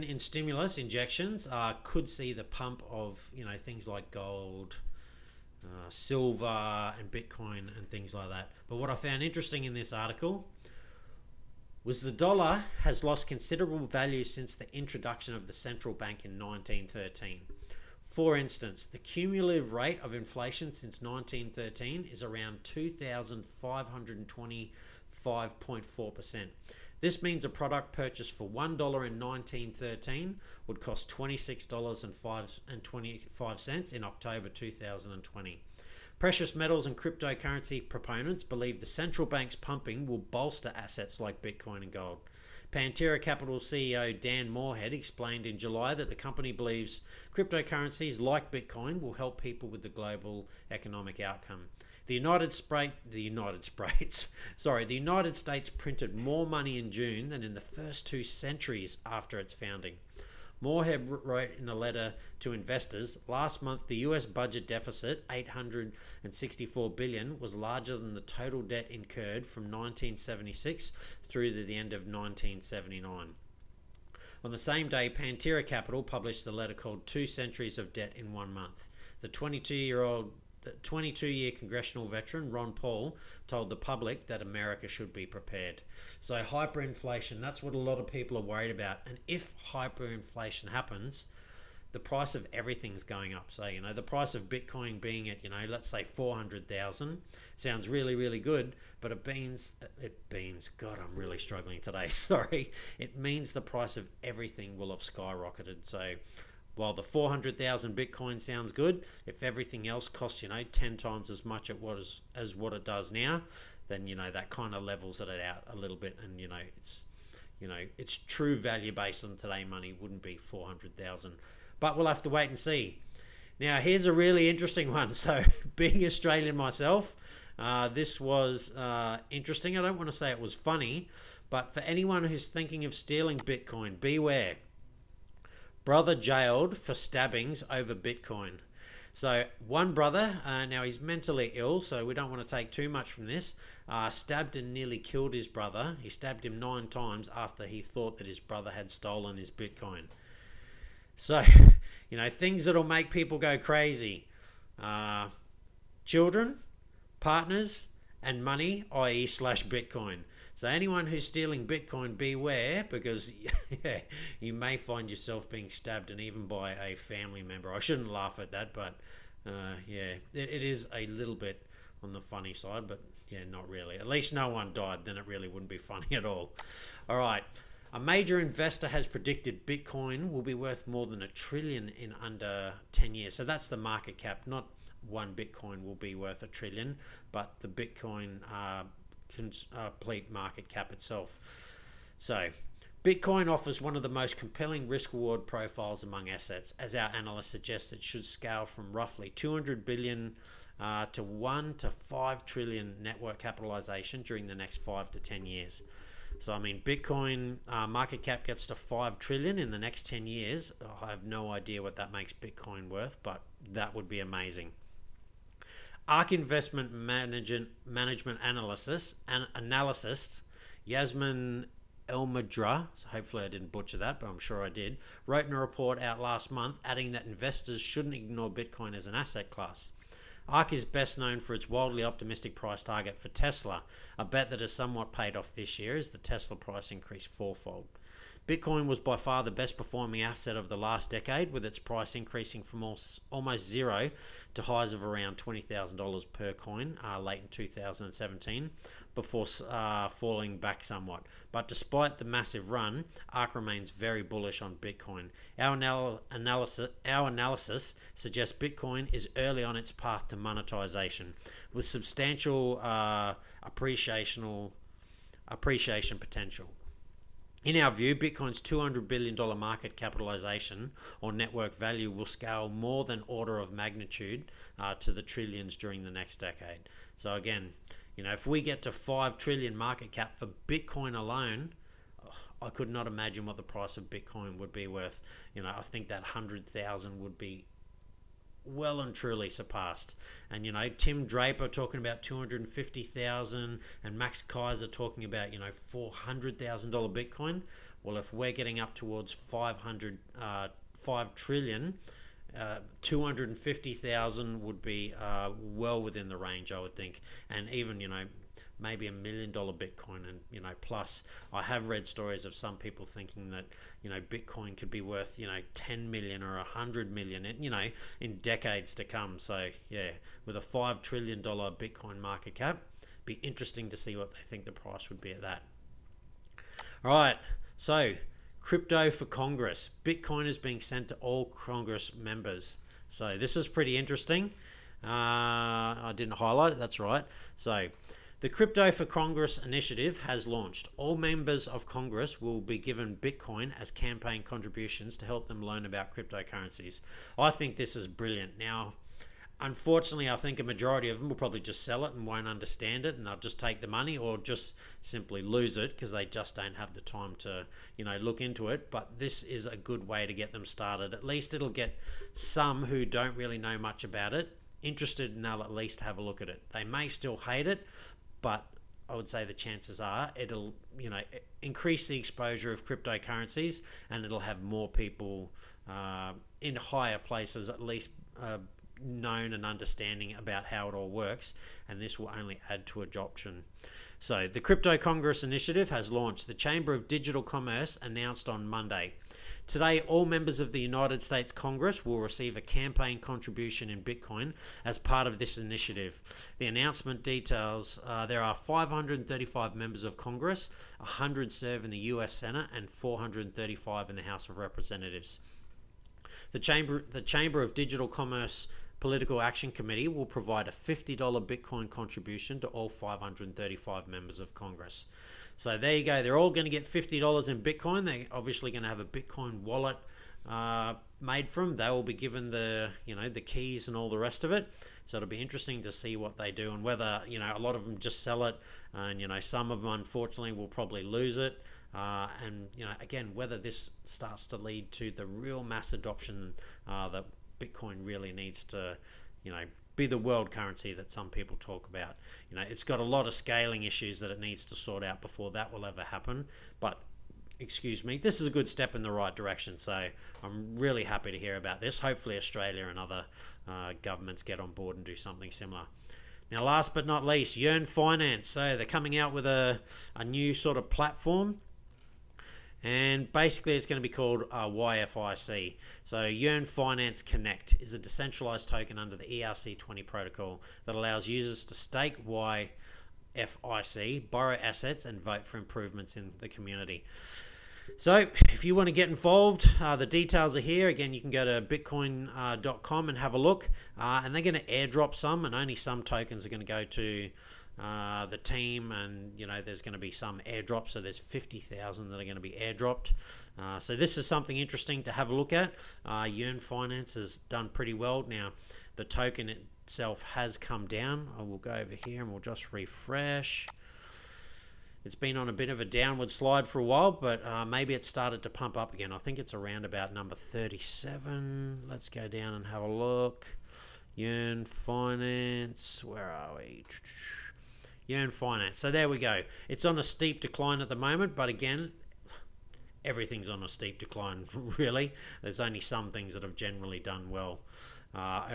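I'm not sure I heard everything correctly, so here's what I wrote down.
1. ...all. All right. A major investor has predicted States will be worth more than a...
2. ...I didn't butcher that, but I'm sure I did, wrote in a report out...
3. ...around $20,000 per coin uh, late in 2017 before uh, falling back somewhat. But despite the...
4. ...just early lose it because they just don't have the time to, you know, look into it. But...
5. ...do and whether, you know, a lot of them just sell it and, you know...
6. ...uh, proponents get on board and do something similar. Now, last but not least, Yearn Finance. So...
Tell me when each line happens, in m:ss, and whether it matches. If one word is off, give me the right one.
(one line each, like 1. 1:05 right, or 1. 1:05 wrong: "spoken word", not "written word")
1. 2:56 wrong: "Bitcoin", not "States"
2. 3:43 right
3. 4:05 right
4. 5:54 wrong: "simply", not "early"
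5. 7:06 right
6. 7:33 wrong: "governments", not "proponents".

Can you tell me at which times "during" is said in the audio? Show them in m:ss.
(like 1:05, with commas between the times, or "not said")
3:24, 4:35.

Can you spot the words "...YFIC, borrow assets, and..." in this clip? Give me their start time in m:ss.
7:52.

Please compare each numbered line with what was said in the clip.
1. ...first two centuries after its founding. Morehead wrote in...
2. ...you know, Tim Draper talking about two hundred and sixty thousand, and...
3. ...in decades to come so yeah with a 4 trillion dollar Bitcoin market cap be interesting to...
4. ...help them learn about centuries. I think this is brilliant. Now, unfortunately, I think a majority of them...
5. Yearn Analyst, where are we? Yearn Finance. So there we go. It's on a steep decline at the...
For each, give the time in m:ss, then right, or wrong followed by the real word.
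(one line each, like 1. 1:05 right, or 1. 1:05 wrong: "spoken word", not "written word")
1. 0:57 right
2. 4:50 wrong: "fifty", not "sixty"
3. 5:18 wrong: "5", not "4"
4. 5:45 wrong: "cryptocurrencies", not "centuries"
5. 8:34 wrong: "Finance", not "Analyst".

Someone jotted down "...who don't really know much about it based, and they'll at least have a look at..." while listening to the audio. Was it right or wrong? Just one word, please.
wrong.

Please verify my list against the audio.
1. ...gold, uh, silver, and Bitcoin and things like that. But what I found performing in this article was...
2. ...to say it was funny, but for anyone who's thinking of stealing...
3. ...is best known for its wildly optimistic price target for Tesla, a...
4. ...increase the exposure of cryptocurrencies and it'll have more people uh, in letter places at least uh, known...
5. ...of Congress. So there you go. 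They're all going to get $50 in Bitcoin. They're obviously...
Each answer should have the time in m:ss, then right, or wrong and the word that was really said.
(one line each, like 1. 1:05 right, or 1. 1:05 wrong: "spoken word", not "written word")
1. 0:04 wrong: "interesting", not "performing"
2. 2:10 right
3. 3:50 right
4. 6:11 wrong: "higher", not "letter"
5. 6:54 right.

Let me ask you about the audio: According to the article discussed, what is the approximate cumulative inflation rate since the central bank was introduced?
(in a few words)
2,525.4%.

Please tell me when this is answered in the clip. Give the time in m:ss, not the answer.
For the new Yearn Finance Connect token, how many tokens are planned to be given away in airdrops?
8:11.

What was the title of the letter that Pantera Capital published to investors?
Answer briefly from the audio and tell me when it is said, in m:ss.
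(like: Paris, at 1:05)
Two Centuries of Debt in One Month, at 1:17.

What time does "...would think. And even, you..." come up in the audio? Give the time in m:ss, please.
5:06.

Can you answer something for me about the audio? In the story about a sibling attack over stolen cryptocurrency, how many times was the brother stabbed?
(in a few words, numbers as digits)
9.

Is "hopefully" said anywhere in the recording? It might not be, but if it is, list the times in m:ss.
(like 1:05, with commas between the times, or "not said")
3:43, 7:31.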